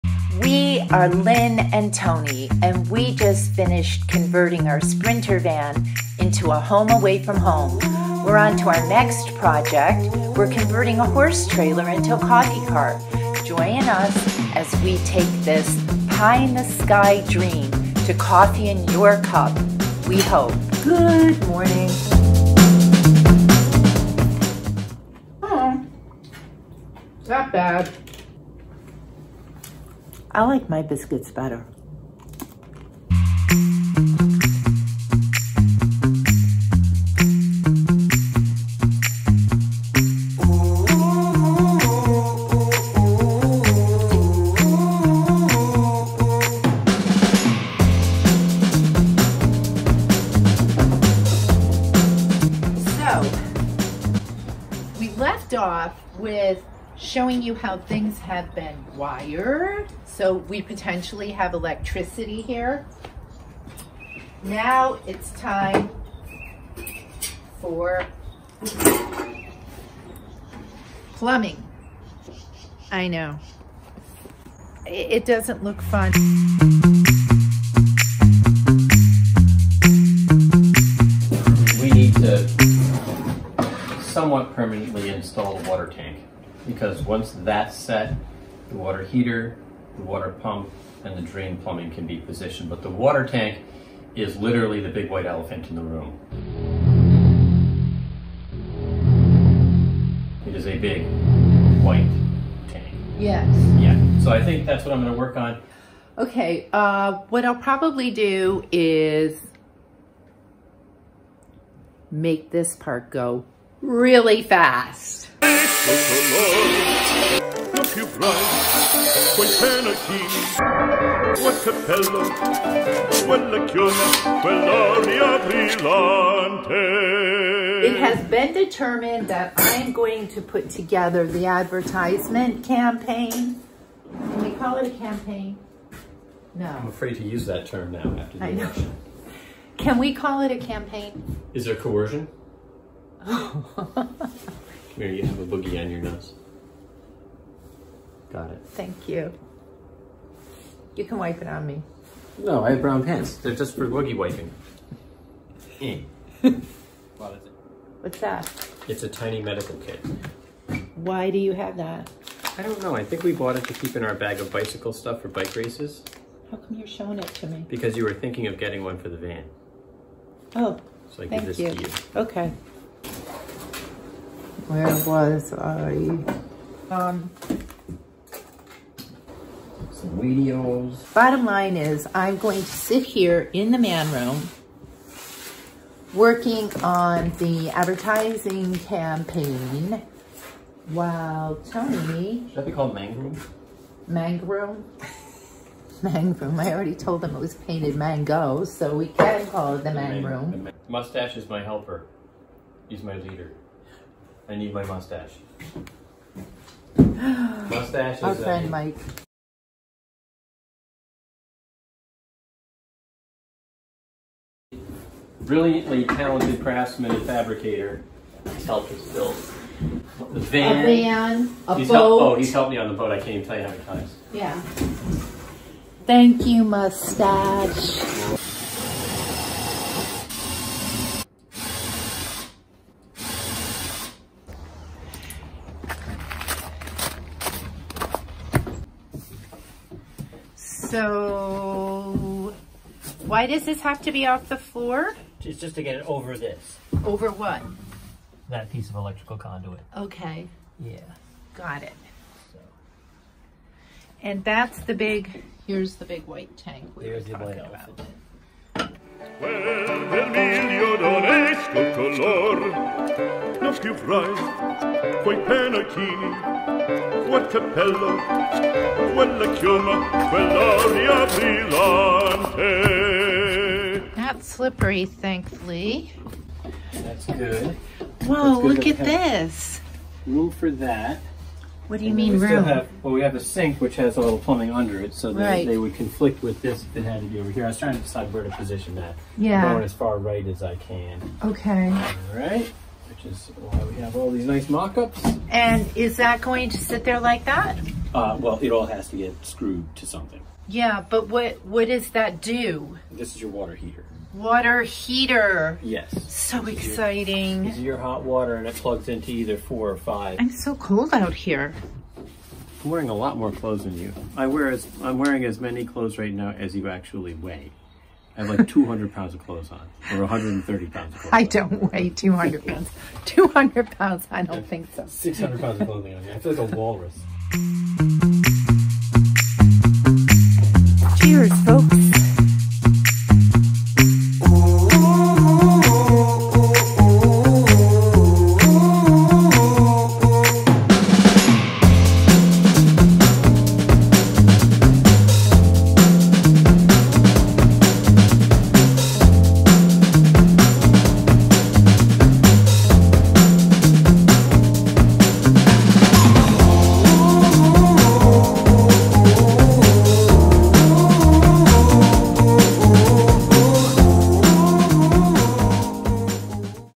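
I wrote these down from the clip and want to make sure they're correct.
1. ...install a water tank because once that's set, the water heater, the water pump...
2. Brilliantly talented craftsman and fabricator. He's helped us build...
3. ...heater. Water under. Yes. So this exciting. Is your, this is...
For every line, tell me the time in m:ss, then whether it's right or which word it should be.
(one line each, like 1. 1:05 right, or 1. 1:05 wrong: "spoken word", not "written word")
1. 1:25 right
2. 3:35 right
3. 5:03 wrong: "heater", not "under".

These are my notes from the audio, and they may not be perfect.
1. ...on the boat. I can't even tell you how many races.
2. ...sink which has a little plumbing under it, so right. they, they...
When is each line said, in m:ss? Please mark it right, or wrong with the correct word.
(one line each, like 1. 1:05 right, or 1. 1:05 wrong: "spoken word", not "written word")
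1. 3:42 wrong: "times", not "races"
2. 4:43 right.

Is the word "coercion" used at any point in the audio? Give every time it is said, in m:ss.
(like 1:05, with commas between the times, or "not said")
2:21.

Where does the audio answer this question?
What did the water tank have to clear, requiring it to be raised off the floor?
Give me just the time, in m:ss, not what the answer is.
4:08.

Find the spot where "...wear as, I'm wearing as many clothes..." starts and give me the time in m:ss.
5:14.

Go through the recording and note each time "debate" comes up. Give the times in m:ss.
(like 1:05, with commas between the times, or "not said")
not said.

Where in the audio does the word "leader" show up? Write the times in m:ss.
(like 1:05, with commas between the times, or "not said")
3:23.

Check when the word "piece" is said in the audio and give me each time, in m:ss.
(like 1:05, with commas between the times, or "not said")
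4:08.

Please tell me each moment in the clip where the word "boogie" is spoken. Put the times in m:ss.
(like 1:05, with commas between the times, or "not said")
2:25, 2:33.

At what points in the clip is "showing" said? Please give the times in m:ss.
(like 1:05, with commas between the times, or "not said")
0:57, 2:46.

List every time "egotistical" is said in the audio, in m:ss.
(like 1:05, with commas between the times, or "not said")
not said.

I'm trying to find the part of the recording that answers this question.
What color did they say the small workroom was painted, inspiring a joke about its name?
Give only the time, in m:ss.
3:17.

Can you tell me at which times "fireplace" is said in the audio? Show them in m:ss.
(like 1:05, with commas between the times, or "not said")
not said.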